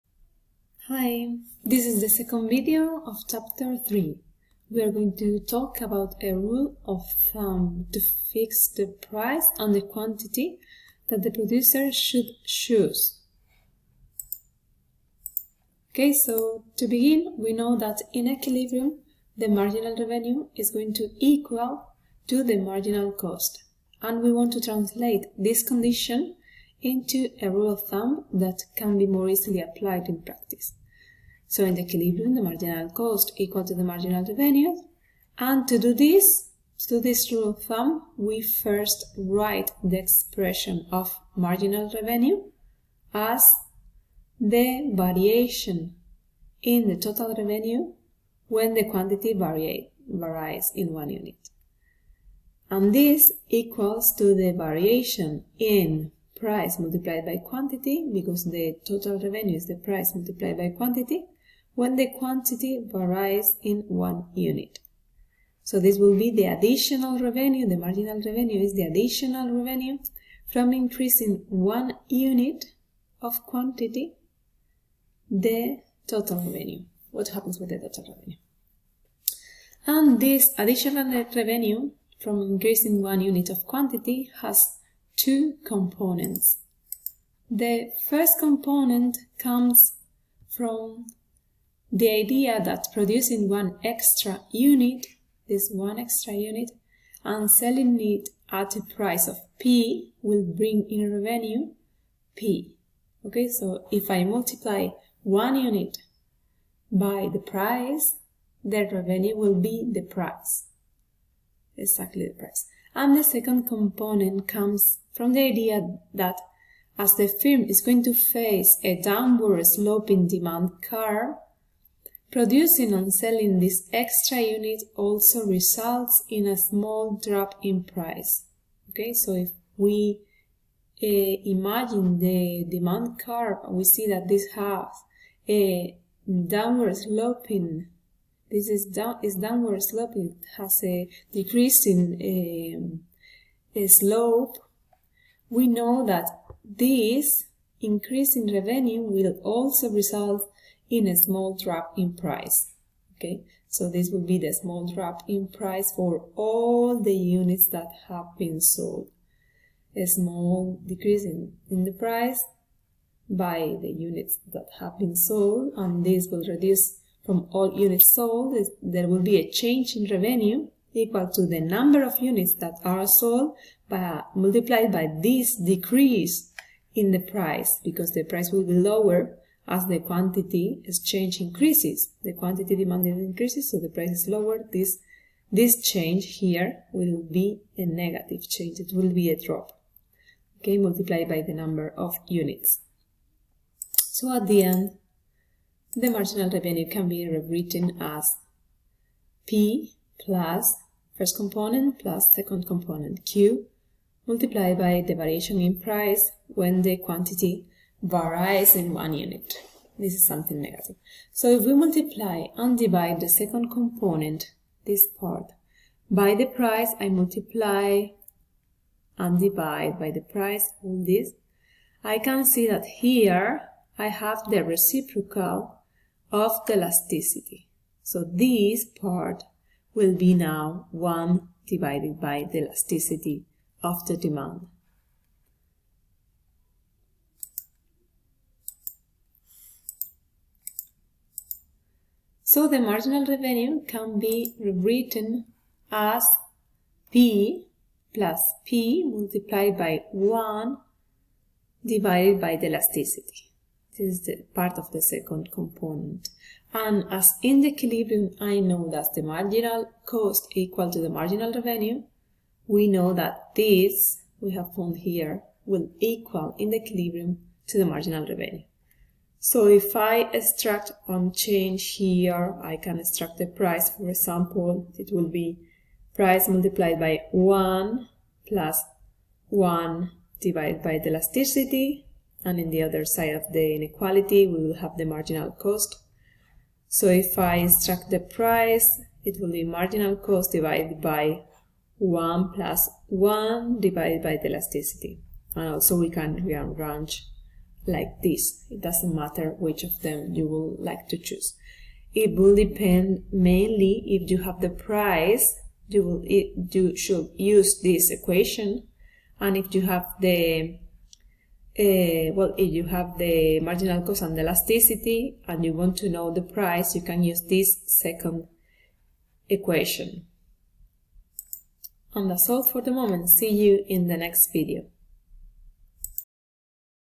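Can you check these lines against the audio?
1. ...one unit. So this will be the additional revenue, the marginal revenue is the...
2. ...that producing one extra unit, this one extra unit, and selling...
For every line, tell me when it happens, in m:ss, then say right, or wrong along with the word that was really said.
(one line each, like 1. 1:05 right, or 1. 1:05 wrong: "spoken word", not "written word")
1. 1:03 right
2. 1:32 right.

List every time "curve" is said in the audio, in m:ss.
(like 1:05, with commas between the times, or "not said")
2:00, 2:13.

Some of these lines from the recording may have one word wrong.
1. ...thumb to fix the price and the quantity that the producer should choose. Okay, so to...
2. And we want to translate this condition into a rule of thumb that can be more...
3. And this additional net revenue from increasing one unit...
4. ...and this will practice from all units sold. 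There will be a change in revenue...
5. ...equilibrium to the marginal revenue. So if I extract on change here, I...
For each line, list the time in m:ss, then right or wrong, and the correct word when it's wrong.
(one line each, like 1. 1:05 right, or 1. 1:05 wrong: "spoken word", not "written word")
1. 0:07 right
2. 0:24 right
3. 1:19 right
4. 2:45 wrong: "reduce", not "practice"
5. 4:26 right.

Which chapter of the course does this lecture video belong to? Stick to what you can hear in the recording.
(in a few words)
3.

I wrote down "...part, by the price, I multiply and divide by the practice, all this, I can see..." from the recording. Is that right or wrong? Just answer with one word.
wrong.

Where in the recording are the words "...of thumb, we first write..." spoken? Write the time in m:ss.
0:37.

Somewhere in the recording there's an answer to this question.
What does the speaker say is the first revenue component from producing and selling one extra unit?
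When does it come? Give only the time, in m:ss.
1:41.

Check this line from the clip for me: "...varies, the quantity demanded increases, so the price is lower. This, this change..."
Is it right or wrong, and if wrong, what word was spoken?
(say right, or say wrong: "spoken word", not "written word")
wrong: "increases", not "varies".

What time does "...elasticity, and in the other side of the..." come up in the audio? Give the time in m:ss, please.
4:41.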